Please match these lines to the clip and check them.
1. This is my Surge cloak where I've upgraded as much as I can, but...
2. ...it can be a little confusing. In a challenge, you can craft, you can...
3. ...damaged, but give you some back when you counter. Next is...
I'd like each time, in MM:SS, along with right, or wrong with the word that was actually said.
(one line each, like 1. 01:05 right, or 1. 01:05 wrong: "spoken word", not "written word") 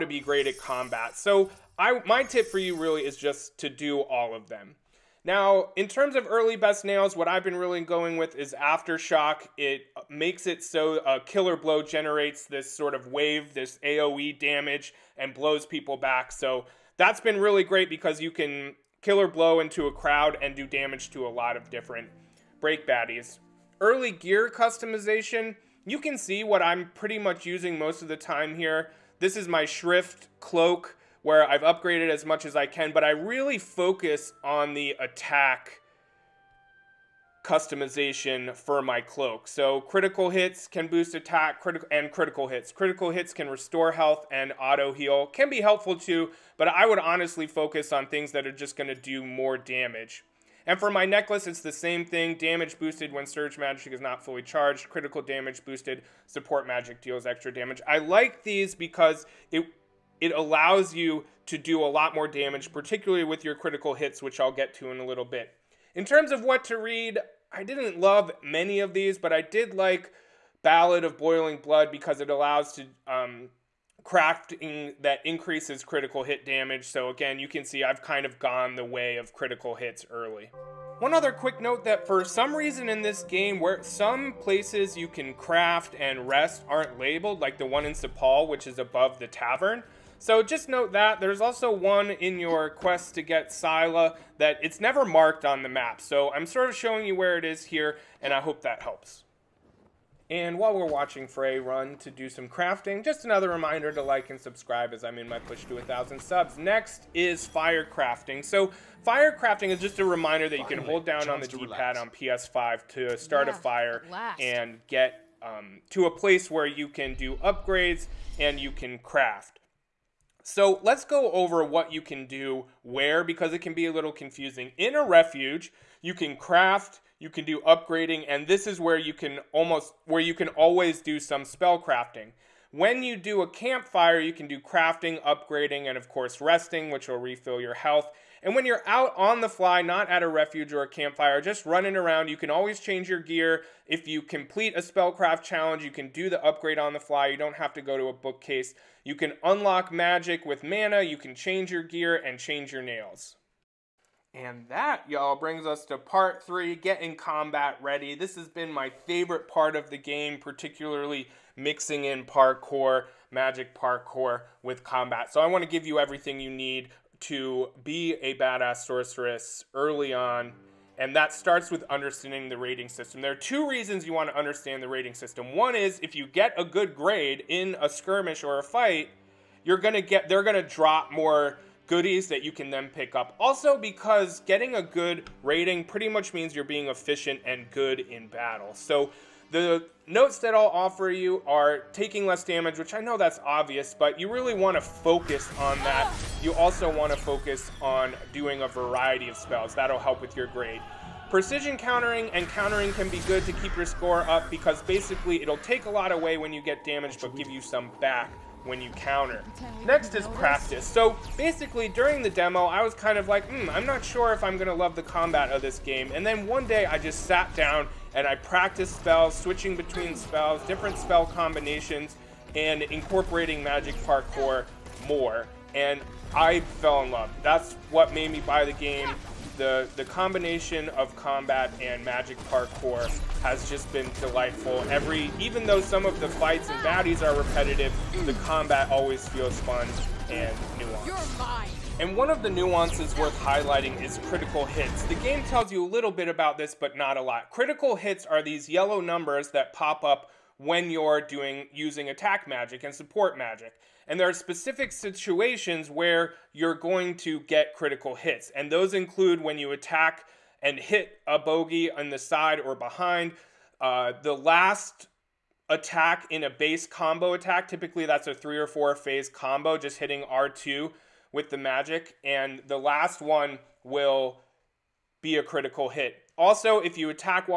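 1. 00:29 wrong: "Shrift", not "Surge"
2. 02:03 wrong: "refuge", not "challenge"
3. 03:26 right.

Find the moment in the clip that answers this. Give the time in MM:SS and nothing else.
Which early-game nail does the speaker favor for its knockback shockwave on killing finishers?
00:08.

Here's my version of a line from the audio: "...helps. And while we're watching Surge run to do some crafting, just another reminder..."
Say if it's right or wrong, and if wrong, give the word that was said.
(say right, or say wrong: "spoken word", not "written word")
wrong: "Frey", not "Surge".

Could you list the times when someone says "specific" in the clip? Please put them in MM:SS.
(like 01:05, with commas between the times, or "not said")
04:14.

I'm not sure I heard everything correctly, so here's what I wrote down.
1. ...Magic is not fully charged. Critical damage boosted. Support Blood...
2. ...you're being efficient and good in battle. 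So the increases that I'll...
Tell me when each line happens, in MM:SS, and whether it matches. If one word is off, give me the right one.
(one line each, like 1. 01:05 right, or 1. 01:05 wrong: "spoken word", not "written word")
1. 00:53 wrong: "Magic", not "Blood"
2. 03:06 wrong: "notes", not "increases".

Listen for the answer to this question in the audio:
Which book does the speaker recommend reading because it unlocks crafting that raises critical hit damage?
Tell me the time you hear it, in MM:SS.
01:10.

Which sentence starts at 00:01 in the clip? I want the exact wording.
So I my tip for you really is just to do all of them.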